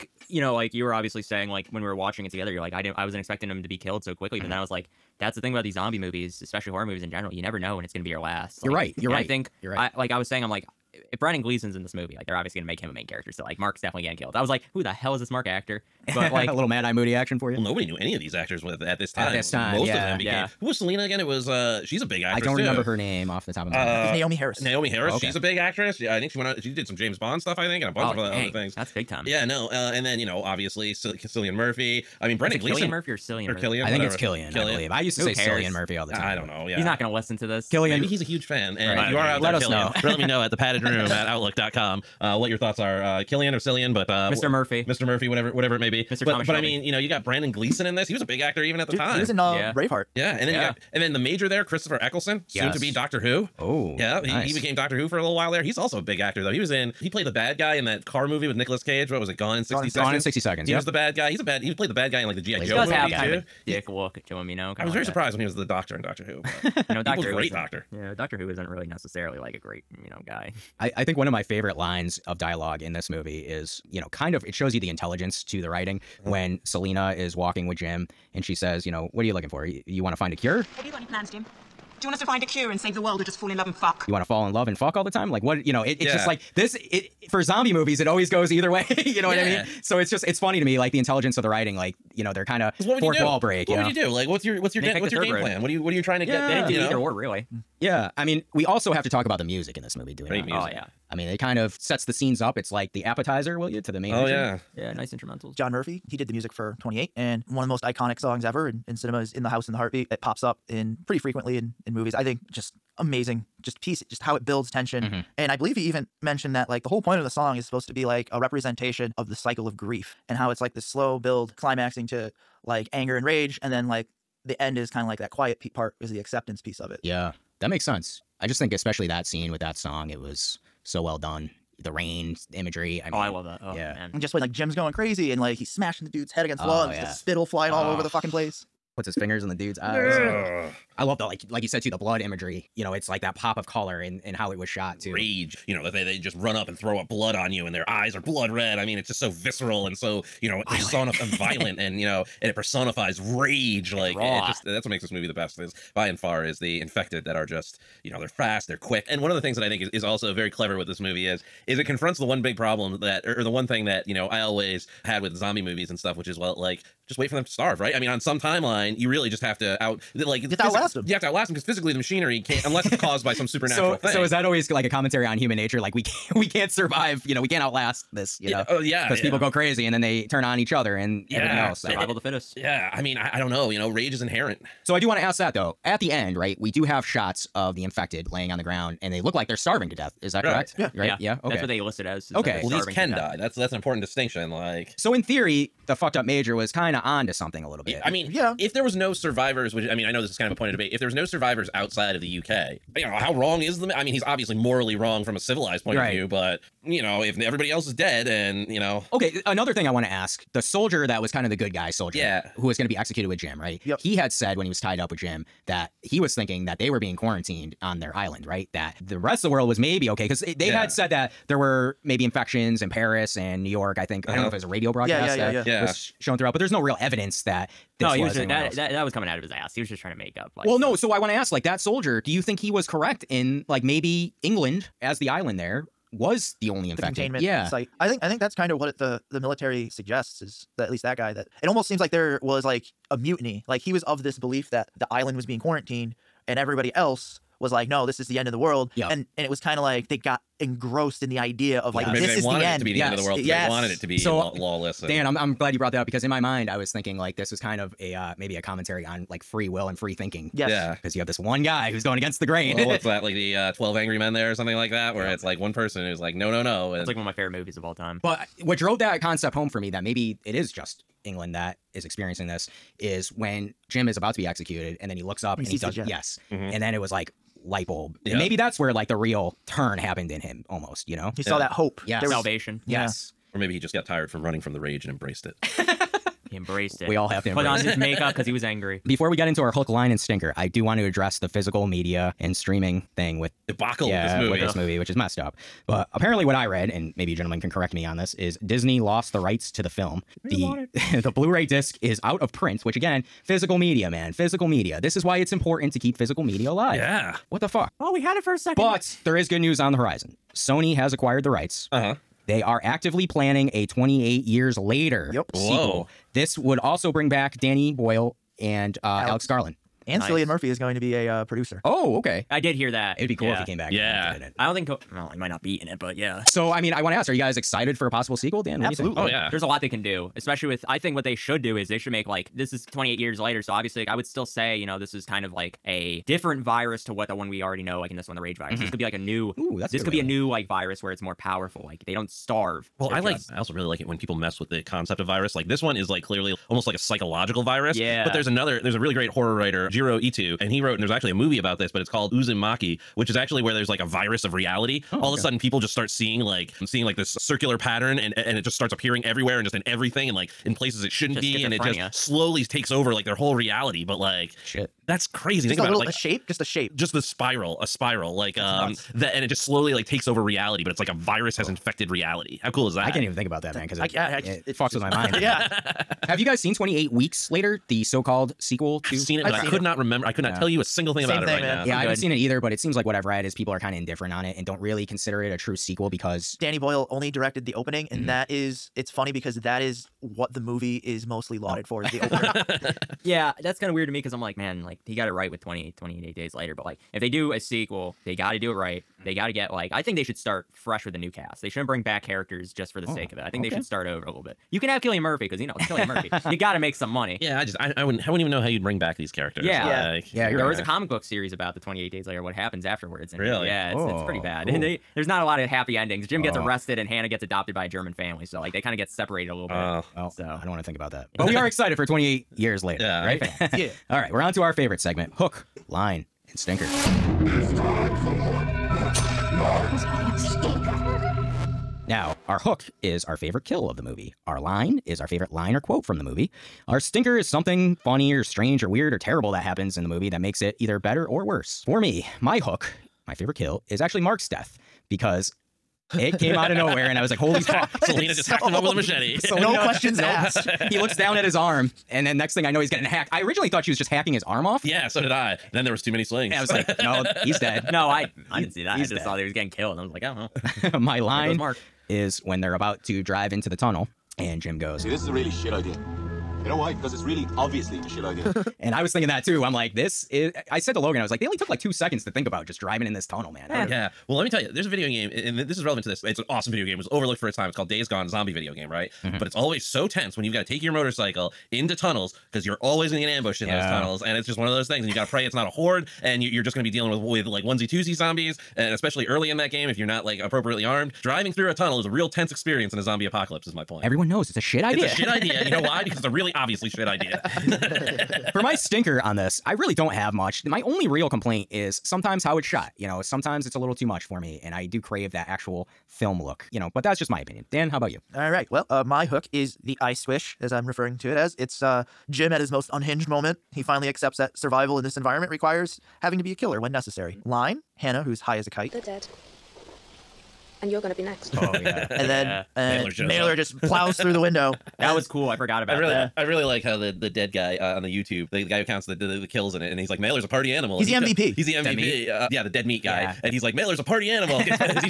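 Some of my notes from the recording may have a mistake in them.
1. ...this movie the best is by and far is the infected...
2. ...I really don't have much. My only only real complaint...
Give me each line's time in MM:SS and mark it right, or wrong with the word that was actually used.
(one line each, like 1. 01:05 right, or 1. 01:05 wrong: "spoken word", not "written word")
1. 02:35 right
2. 08:19 right.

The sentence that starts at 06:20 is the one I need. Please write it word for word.
tell you a single thing Same about it thing, right man.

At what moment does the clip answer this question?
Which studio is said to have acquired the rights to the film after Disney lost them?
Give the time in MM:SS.
05:10.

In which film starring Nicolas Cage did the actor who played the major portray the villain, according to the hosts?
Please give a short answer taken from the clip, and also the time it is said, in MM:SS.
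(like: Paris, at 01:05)
Gone in 60 Seconds, at 00:59.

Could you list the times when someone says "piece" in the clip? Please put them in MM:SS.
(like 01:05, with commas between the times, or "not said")
01:53, 02:06.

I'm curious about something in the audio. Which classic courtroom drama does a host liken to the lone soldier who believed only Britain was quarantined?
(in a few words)
Twelve Angry Men.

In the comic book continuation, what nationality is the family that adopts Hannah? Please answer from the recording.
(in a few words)
German.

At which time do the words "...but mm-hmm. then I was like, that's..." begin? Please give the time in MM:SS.
00:04.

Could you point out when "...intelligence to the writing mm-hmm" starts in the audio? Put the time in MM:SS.
01:14.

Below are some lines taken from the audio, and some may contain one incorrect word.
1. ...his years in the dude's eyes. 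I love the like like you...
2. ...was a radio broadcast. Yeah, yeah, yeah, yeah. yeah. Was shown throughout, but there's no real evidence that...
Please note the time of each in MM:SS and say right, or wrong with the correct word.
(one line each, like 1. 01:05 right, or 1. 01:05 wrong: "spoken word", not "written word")
1. 02:19 wrong: "fingers", not "years"
2. 03:44 right.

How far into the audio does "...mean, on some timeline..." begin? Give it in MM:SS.
02:47.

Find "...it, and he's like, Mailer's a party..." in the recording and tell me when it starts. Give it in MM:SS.
08:49.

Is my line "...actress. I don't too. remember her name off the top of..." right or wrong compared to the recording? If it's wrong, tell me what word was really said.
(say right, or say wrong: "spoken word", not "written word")
right.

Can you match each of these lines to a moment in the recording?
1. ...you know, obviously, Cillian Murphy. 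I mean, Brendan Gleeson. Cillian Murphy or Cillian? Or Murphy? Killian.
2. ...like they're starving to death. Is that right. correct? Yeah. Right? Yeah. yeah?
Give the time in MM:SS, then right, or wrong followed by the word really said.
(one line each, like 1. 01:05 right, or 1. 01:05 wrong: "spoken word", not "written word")
1. 00:30 right
2. 03:09 right.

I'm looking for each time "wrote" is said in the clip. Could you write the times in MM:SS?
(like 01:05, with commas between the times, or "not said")
05:50.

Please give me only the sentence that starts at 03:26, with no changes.
of view, but you know, if everybody else is dead and, you know.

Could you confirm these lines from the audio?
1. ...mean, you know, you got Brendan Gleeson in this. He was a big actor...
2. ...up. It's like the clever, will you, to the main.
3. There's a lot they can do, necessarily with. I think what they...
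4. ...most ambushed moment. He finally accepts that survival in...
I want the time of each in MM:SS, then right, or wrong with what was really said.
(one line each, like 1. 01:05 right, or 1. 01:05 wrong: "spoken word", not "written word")
1. 00:46 right
2. 01:42 wrong: "appetizer", not "clever"
3. 05:29 wrong: "especially", not "necessarily"
4. 08:32 wrong: "unhinged", not "ambushed".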